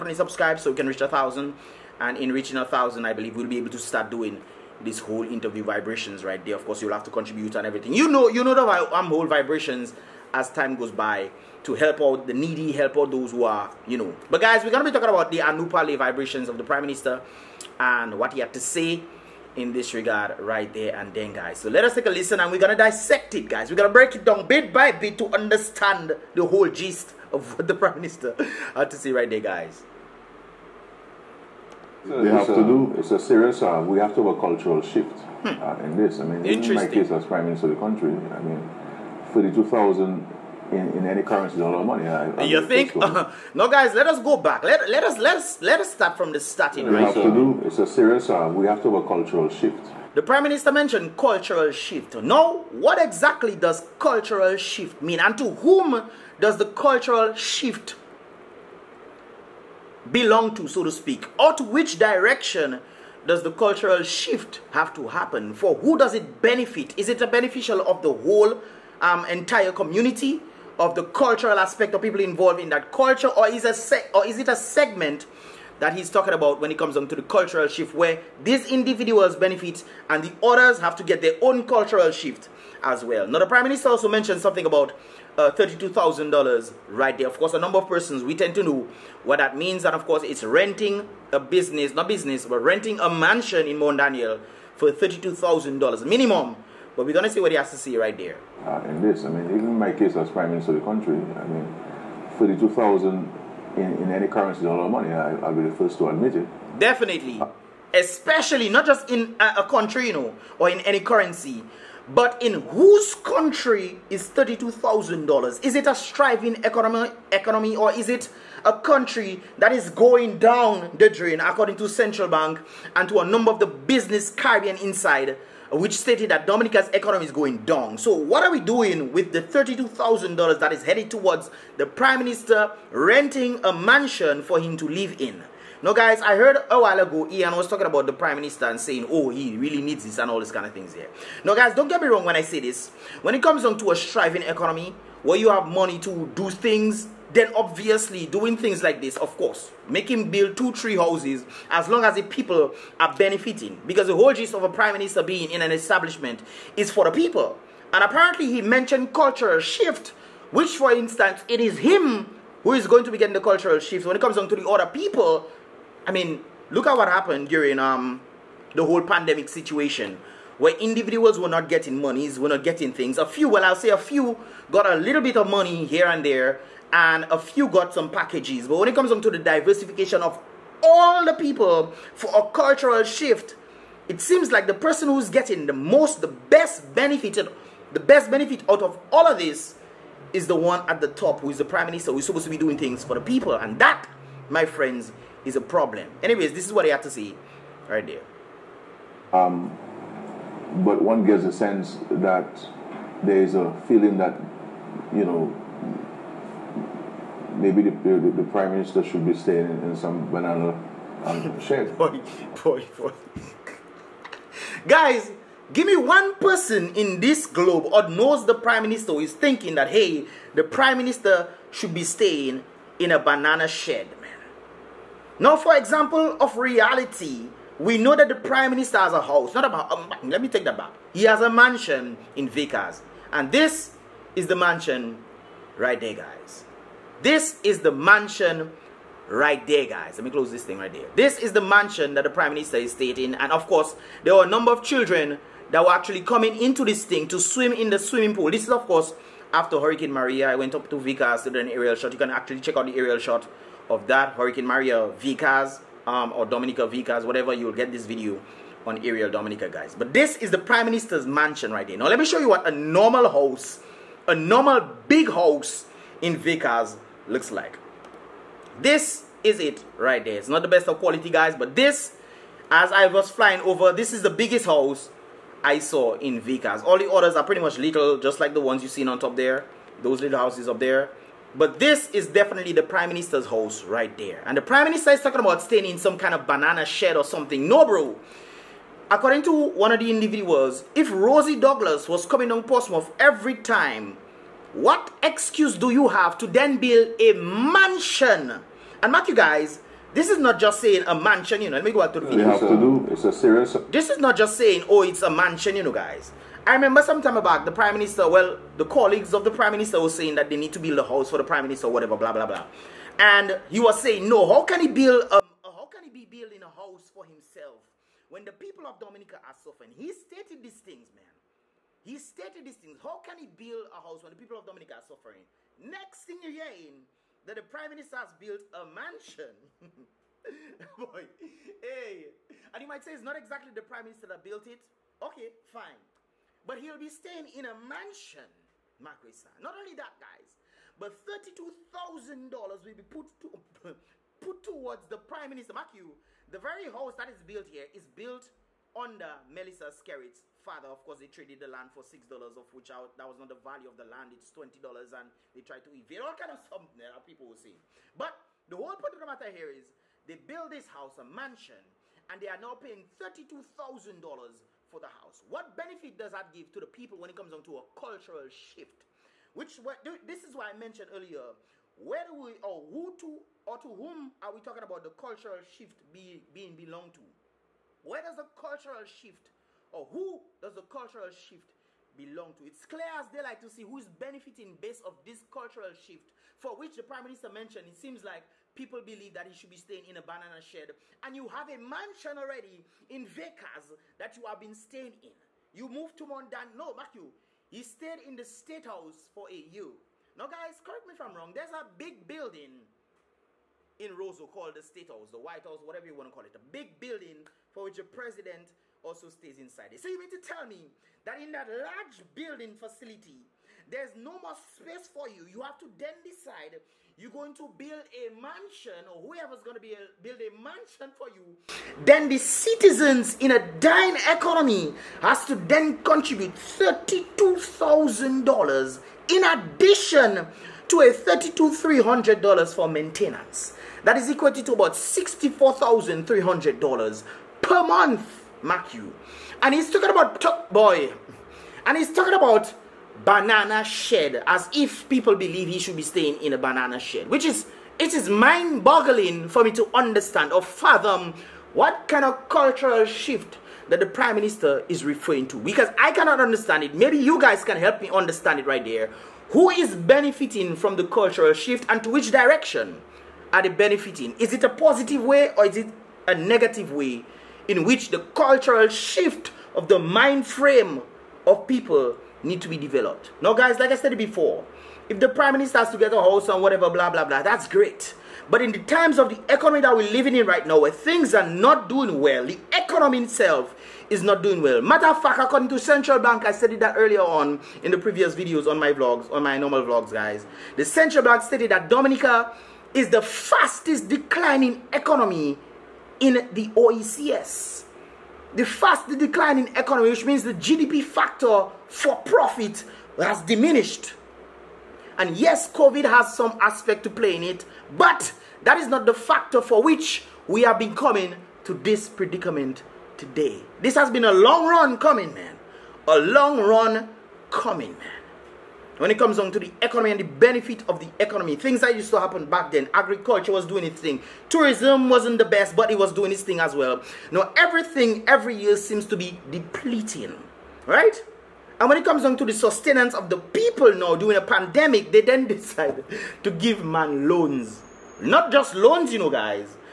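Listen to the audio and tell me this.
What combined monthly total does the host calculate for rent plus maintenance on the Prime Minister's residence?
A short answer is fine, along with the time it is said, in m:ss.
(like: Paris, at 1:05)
$64,300, at 7:14.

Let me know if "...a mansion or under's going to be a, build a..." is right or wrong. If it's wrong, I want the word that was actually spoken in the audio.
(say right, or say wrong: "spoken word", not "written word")
wrong: "whoever", not "under".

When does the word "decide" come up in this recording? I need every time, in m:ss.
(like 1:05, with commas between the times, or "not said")
6:56, 8:55.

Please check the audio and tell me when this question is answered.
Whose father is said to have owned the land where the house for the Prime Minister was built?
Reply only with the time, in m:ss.
5:49.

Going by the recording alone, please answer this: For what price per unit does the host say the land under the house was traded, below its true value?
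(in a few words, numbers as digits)
$6.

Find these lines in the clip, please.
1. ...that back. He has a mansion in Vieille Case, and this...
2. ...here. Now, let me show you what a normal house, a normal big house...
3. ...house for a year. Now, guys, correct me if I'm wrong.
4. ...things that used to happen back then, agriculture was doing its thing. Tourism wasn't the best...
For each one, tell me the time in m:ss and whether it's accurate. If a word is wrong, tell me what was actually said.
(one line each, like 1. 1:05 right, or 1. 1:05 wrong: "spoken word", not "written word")
1. 3:50 right
2. 4:21 right
3. 6:38 right
4. 8:41 right.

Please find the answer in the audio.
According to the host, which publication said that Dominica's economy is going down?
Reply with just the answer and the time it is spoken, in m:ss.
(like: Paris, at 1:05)
Caribbean Insider, at 2:04.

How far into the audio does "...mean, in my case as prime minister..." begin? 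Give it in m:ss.
0:36.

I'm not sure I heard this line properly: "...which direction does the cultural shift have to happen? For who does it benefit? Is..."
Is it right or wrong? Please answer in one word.
right.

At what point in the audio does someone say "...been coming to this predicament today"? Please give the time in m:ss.
8:30.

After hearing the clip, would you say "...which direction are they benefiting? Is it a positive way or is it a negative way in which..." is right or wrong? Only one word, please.
right.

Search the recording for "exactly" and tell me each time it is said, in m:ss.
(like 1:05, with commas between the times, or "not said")
0:53, 5:33.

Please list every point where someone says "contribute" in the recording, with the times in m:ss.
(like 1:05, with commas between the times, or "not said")
0:07, 7:05.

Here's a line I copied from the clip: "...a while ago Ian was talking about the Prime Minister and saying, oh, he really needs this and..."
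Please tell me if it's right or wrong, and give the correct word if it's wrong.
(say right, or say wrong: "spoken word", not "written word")
right.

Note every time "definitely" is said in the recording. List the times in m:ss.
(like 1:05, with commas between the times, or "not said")
1:46, 4:42.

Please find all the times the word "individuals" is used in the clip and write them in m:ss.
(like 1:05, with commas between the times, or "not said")
1:18, 2:50, 4:50.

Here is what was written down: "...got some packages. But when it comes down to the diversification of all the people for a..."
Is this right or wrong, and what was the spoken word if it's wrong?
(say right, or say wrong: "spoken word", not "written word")
right.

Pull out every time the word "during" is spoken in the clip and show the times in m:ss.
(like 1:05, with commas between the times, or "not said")
2:47, 8:54.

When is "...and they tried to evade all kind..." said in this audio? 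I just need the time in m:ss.
5:55.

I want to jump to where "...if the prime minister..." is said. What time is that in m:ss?
7:55.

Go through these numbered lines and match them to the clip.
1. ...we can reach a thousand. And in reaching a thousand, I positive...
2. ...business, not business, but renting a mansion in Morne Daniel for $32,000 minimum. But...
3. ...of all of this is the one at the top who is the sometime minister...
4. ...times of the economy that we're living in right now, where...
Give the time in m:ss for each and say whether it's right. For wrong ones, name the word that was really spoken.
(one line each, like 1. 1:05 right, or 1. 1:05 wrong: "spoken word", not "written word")
1. 0:00 wrong: "believe", not "positive"
2. 1:31 right
3. 3:08 wrong: "prime", not "sometime"
4. 7:58 right.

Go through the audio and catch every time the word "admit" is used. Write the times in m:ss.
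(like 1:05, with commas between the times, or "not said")
1:46.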